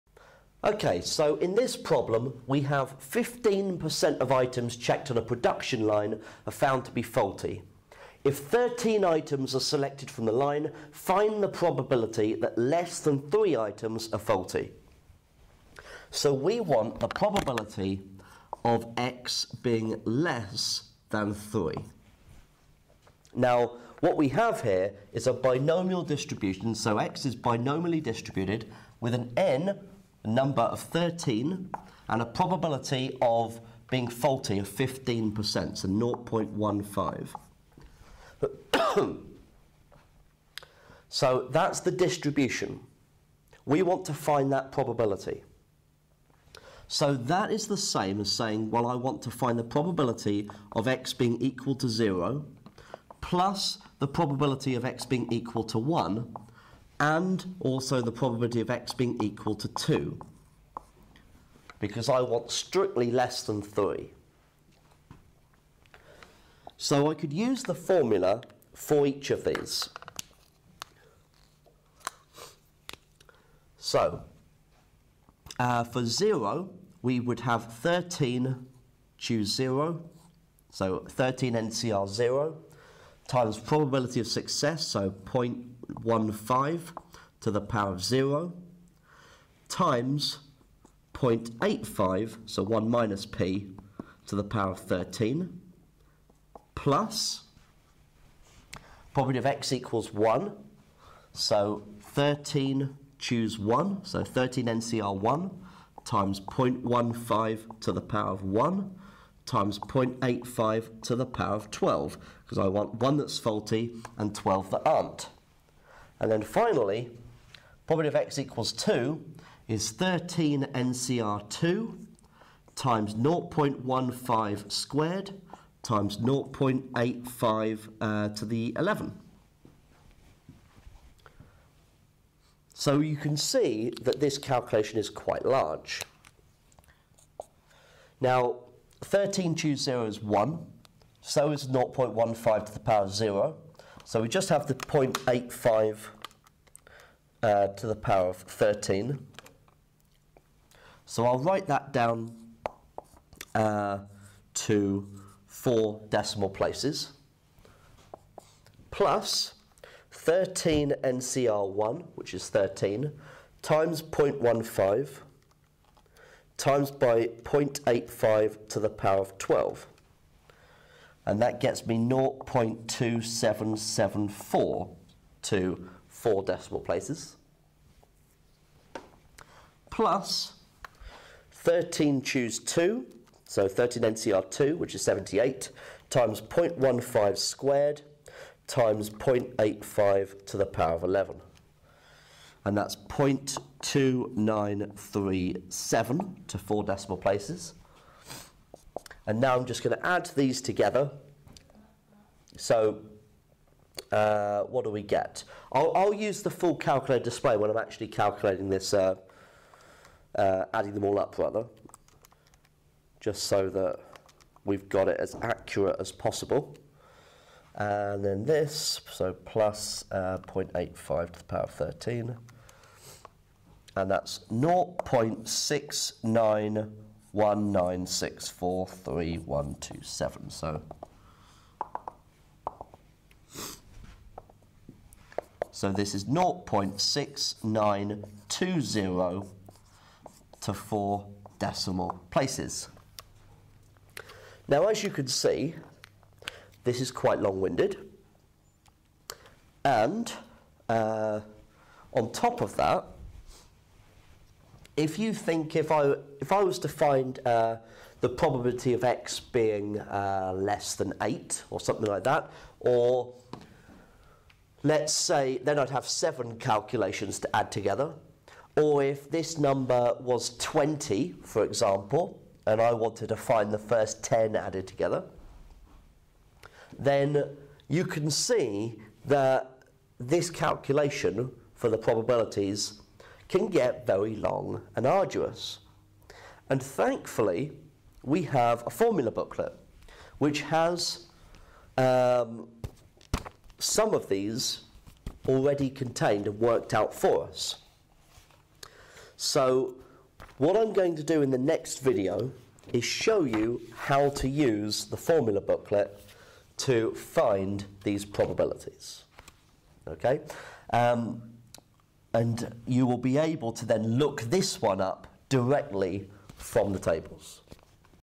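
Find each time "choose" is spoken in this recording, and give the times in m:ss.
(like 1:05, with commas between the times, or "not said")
1:19, 1:43, 2:19, 3:02.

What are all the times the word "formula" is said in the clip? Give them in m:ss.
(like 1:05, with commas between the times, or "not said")
1:07, 4:48, 5:05.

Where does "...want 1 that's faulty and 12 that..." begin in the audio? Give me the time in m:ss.
1:52.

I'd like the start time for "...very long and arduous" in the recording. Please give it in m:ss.
4:44.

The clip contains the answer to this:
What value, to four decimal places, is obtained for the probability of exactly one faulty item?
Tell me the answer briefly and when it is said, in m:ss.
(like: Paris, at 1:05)
0.2774, at 2:51.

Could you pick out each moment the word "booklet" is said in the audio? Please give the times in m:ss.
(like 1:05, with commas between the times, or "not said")
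4:49, 5:05.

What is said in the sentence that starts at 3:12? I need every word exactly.
And that's 0.2937 to four decimal places.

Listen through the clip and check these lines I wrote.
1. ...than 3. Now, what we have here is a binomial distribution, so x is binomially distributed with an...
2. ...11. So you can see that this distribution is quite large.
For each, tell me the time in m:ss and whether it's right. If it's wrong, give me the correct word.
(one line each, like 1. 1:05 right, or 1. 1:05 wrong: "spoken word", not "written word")
1. 0:21 right
2. 2:08 wrong: "calculation", not "distribution".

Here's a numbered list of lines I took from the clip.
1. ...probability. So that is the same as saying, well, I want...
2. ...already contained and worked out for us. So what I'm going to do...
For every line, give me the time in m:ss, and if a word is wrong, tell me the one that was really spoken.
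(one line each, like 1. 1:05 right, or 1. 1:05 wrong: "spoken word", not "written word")
1. 0:44 right
2. 4:55 right.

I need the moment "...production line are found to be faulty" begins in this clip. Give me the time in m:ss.
0:05.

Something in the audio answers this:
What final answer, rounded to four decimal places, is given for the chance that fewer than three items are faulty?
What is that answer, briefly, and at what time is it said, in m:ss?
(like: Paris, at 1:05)
0.6920, at 3:56.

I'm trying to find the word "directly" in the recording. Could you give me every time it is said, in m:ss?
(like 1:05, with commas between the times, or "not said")
5:15.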